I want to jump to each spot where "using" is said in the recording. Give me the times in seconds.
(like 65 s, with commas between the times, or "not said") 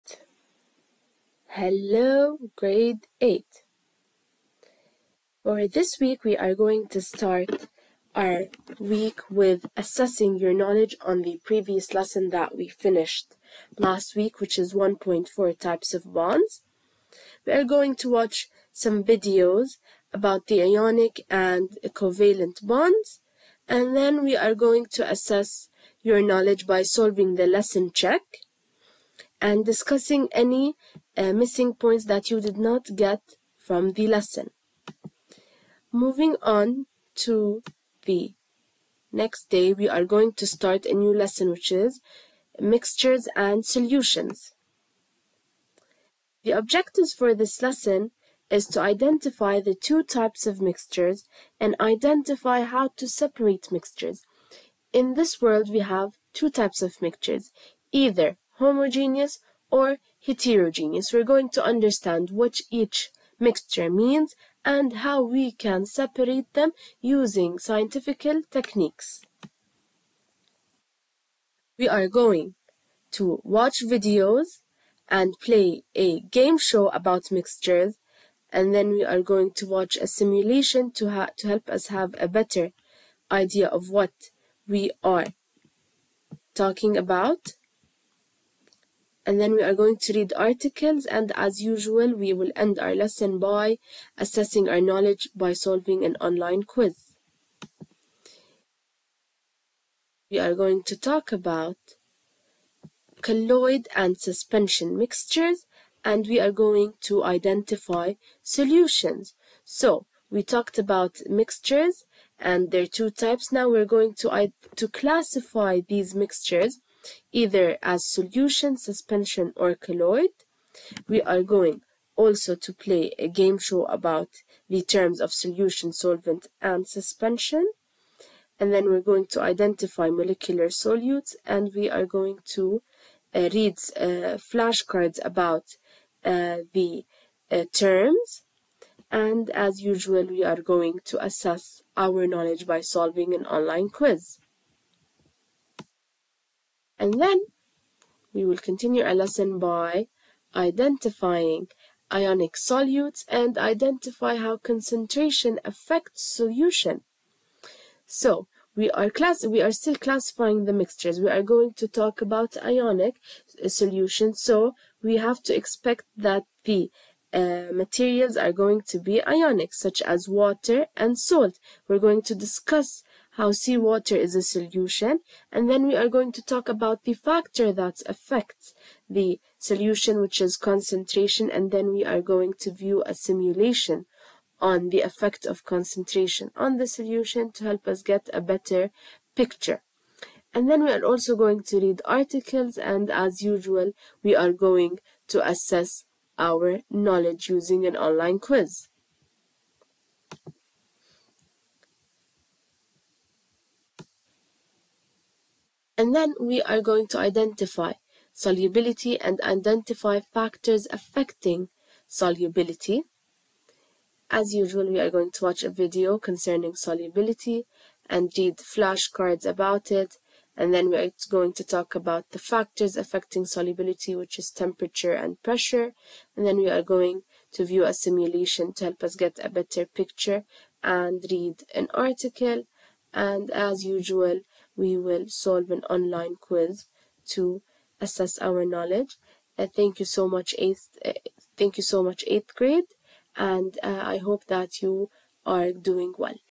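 67 s, 197 s.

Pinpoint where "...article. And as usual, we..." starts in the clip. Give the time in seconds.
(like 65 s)
231 s.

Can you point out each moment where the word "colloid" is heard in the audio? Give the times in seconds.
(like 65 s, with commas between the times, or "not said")
103 s, 119 s.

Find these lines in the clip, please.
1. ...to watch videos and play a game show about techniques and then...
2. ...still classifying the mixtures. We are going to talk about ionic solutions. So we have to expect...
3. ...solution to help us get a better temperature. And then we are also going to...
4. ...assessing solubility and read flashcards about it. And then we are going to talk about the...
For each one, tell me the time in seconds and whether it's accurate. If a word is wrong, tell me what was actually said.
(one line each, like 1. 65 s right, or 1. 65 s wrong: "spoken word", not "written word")
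1. 73 s wrong: "mixtures", not "techniques"
2. 159 s right
3. 186 s wrong: "picture", not "temperature"
4. 216 s wrong: "concerning", not "assessing".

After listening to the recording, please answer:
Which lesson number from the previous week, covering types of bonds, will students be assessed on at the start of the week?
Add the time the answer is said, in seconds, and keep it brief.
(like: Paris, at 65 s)
1.4, at 14 s.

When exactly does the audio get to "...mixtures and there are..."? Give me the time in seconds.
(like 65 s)
111 s.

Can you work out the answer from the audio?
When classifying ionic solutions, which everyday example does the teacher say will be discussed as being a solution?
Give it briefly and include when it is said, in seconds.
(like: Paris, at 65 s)
Seawater, at 173 s.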